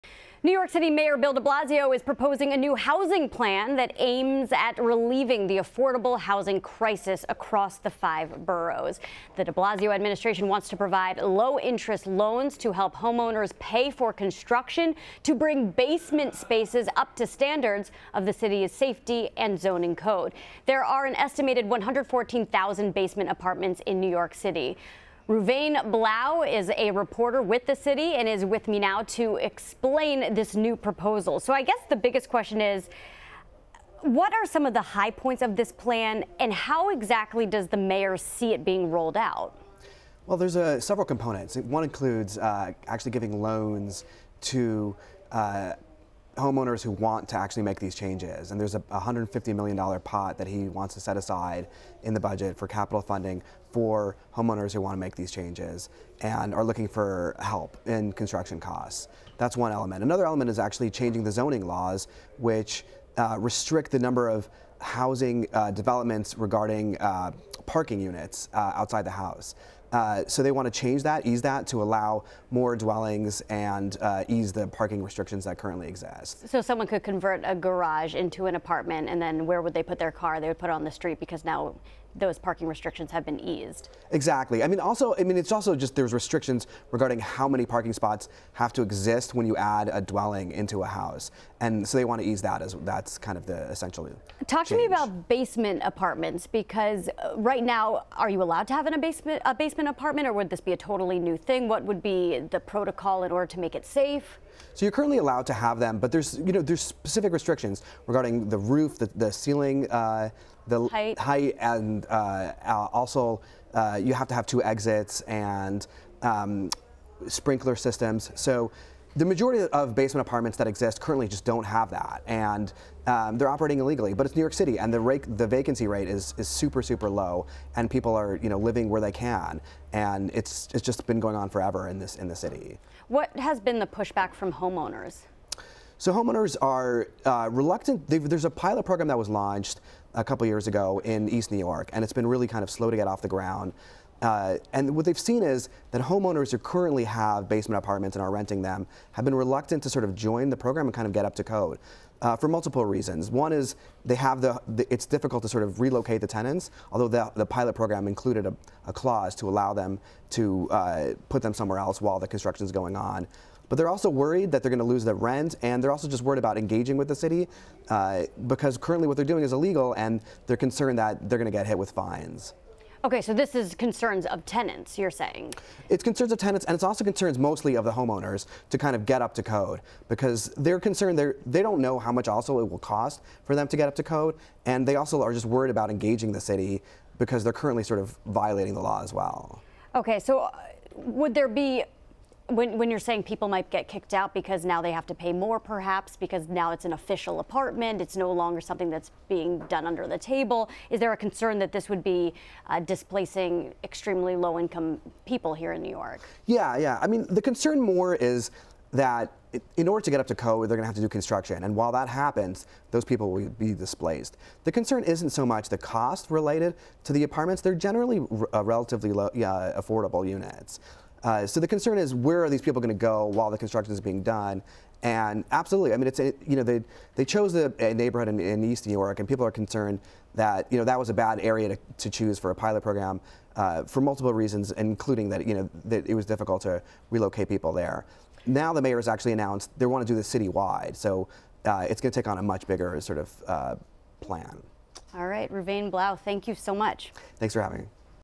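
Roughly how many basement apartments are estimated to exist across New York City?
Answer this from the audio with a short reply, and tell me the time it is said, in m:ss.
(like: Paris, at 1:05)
114,000, at 0:21.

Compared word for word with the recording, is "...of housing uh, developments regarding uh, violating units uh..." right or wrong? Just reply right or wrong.
wrong.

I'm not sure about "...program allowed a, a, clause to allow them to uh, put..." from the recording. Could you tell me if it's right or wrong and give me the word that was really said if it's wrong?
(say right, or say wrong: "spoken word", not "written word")
wrong: "included", not "allowed".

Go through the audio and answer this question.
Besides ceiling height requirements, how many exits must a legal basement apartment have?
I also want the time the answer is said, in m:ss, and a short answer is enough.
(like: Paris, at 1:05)
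2, at 1:54.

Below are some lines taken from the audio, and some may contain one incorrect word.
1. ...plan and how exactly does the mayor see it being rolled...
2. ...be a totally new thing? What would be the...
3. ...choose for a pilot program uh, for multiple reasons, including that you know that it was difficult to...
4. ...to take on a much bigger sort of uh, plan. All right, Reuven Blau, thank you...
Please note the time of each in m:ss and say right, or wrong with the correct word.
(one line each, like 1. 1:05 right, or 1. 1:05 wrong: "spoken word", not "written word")
1. 0:35 right
2. 1:40 right
3. 3:52 right
4. 4:02 right.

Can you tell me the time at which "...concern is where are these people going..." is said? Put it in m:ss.
3:41.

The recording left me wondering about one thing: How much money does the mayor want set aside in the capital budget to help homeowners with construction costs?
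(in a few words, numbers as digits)
$150 million.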